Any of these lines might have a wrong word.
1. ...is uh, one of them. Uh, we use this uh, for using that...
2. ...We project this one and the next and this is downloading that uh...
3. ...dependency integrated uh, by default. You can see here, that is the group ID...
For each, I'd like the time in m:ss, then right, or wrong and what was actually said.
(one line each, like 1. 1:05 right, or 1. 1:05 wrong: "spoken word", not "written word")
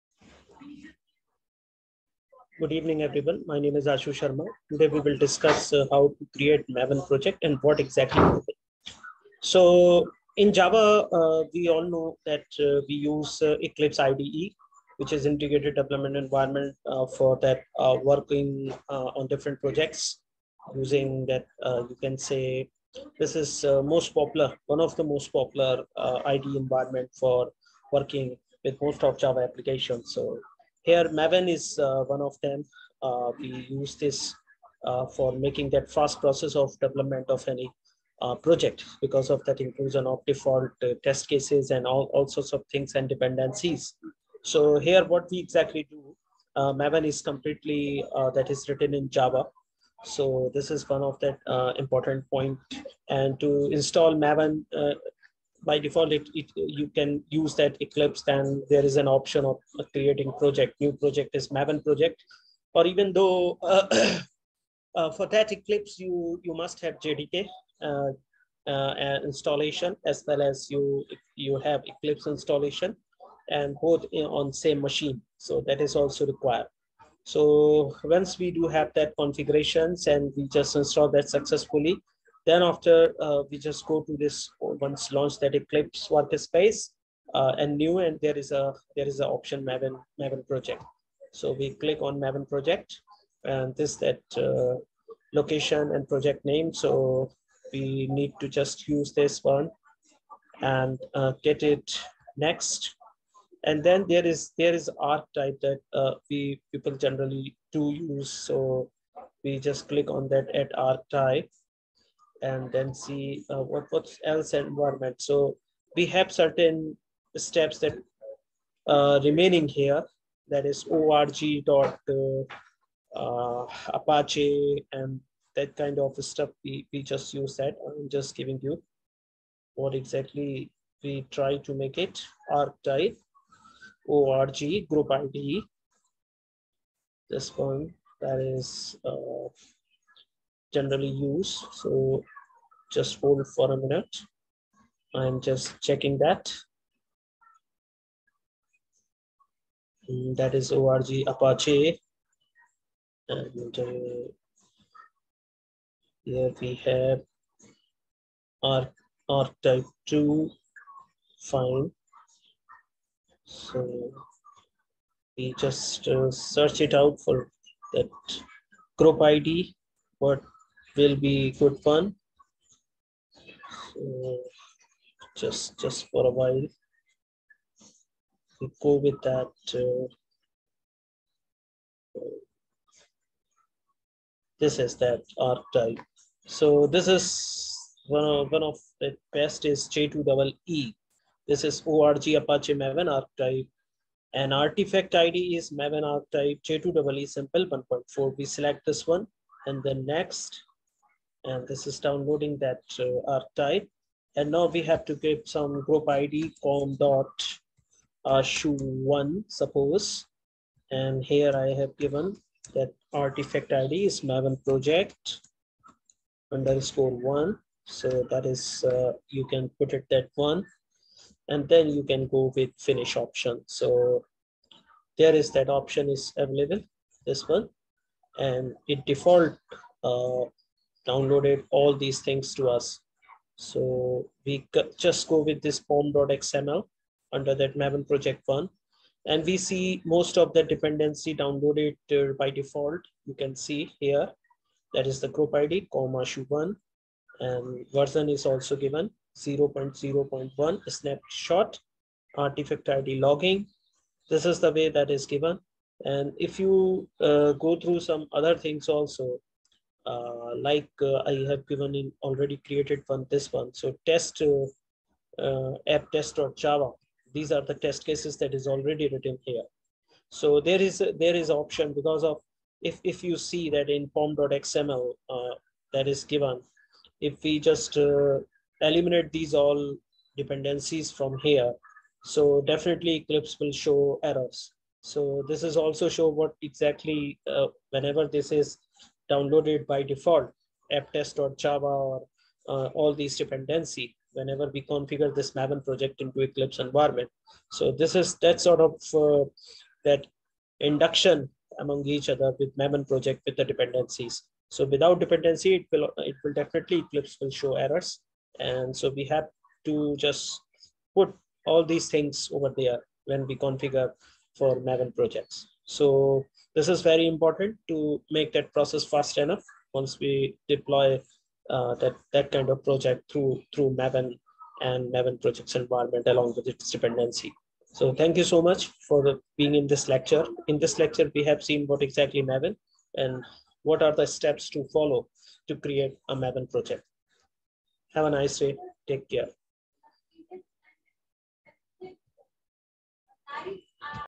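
1. 0:31 wrong: "making", not "using"
2. 3:18 wrong: "select", not "project"
3. 4:00 wrong: "downloaded", not "integrated".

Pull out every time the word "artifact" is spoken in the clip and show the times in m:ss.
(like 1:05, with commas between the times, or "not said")
3:14, 3:33, 4:12.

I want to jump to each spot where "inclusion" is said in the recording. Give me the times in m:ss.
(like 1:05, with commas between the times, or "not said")
0:39.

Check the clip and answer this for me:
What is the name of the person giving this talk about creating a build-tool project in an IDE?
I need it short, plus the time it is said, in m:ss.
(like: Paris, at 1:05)
Ashu Sharma, at 0:03.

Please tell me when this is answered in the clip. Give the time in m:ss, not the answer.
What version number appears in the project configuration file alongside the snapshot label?
4:09.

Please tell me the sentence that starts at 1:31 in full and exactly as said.
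So we click on Maven project and this that uh, location and project name.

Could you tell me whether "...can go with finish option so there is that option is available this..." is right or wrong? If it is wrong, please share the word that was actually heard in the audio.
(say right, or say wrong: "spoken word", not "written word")
right.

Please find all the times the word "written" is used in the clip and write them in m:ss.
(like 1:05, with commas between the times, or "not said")
0:48, 4:29.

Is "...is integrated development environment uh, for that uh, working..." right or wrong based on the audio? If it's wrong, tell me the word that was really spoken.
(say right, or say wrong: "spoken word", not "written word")
right.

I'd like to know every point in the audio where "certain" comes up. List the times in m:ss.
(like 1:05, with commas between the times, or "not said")
1:56.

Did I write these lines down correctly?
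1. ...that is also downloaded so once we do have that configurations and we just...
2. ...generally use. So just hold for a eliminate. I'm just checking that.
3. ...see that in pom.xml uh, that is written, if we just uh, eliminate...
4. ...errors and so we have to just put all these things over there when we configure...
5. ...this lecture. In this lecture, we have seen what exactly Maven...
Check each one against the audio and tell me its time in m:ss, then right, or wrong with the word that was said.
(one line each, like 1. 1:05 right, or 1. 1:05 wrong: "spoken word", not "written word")
1. 1:15 wrong: "required", not "downloaded"
2. 2:20 wrong: "minute", not "eliminate"
3. 4:33 wrong: "given", not "written"
4. 5:07 right
5. 5:29 right.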